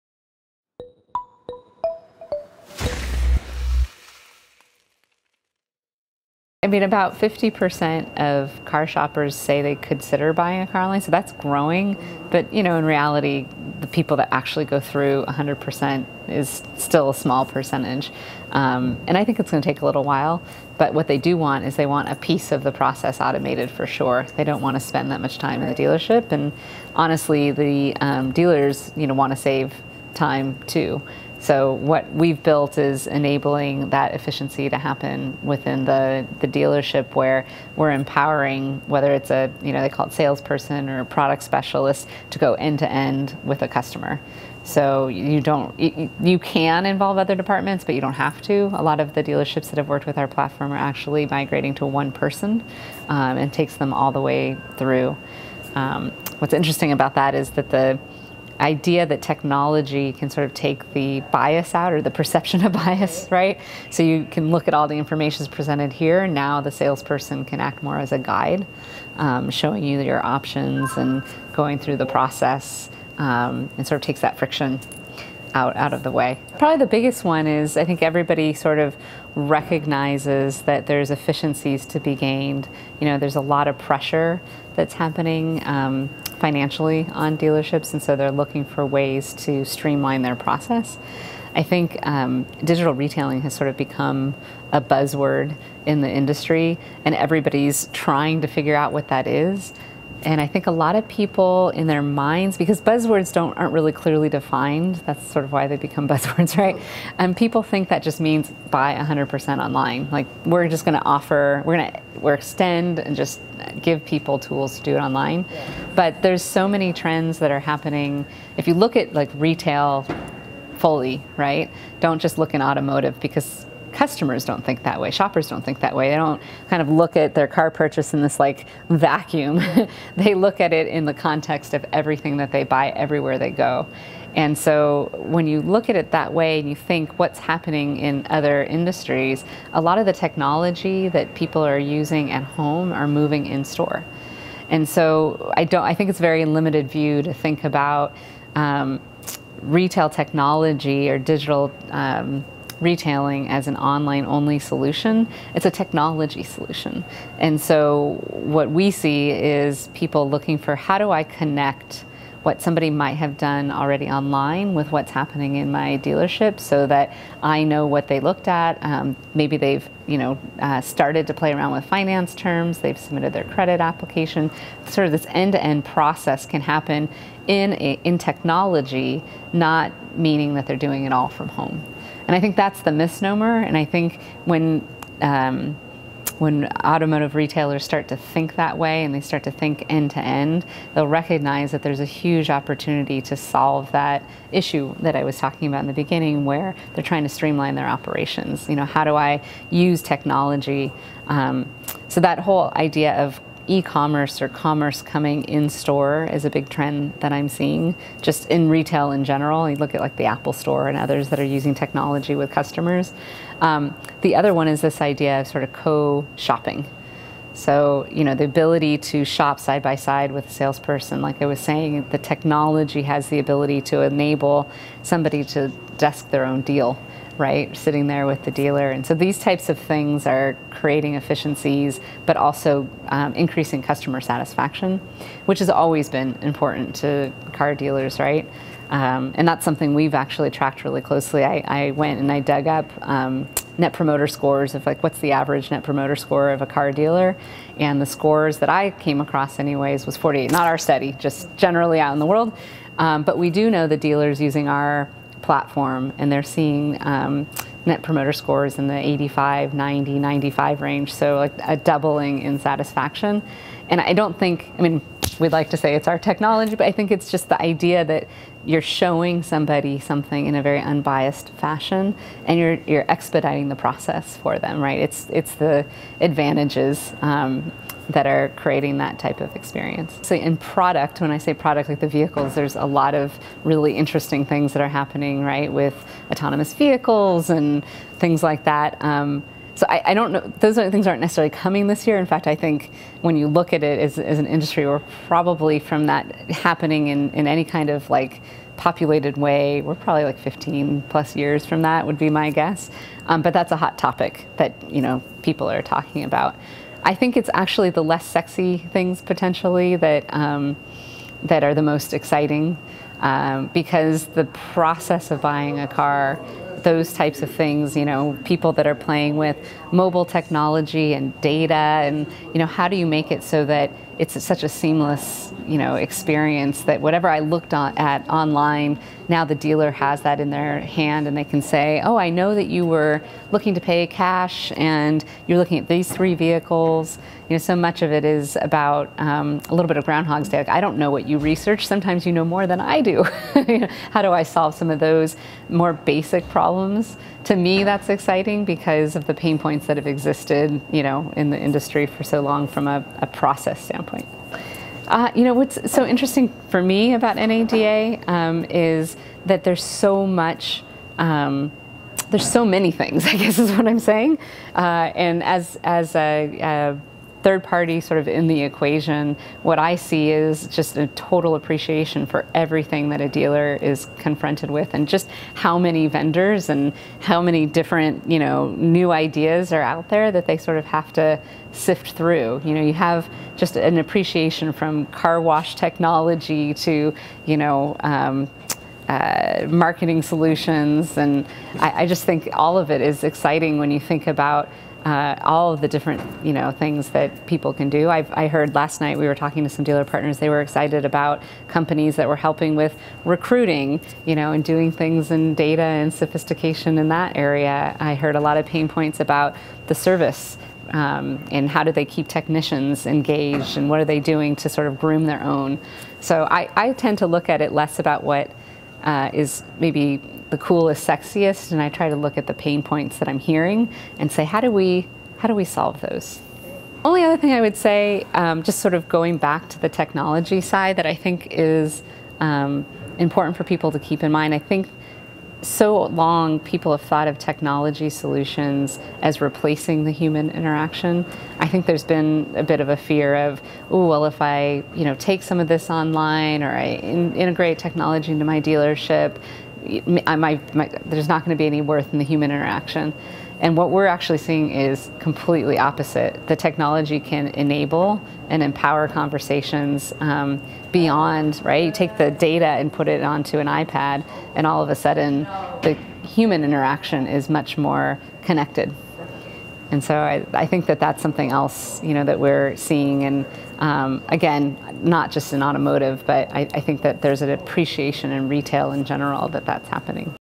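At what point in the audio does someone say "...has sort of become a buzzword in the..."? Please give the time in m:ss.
1:33.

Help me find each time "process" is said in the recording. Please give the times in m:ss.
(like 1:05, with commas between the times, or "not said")
0:22, 1:12, 1:30, 2:55, 4:33, 5:14, 5:53.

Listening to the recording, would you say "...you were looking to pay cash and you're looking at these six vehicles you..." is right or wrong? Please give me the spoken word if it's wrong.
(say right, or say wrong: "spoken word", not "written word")
wrong: "three", not "six".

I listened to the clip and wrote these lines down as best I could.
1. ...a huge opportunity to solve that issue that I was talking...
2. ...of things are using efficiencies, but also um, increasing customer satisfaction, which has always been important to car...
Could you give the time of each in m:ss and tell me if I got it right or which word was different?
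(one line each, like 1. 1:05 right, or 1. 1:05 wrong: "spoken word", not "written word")
1. 3:11 right
2. 3:49 wrong: "creating", not "using".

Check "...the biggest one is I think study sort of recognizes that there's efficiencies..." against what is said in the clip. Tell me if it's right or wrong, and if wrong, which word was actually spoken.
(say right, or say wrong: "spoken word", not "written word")
wrong: "everybody", not "study".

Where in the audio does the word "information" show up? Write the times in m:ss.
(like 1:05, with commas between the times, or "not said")
1:04.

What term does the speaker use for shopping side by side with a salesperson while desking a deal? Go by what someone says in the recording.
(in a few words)
co-shopping.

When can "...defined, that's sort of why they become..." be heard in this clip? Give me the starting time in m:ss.
1:44.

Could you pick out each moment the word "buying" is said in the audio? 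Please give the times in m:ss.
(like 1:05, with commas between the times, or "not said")
0:10, 5:15.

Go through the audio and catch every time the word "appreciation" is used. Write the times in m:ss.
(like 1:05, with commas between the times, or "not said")
6:11, 6:23, 7:57.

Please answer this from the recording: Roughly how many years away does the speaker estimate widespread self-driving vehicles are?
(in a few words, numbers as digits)
15 plus years.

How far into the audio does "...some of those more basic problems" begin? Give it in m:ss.
5:44.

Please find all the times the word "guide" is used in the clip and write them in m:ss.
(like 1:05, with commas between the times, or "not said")
1:08.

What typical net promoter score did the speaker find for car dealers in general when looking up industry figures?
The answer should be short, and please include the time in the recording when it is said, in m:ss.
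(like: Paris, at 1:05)
48, at 4:10.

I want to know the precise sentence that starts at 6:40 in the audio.
They were excited about companies that were helping with recruiting, you know, and doing things in data and sophistication in that area.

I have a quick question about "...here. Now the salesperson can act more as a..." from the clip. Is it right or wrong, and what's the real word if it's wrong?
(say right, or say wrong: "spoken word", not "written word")
right.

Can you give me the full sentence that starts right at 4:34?
It's, it's the advantages um, that are creating that type of experience.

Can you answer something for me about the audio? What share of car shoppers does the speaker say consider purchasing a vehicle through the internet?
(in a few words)
50%.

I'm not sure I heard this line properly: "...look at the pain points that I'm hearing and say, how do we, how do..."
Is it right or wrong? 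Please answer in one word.
right.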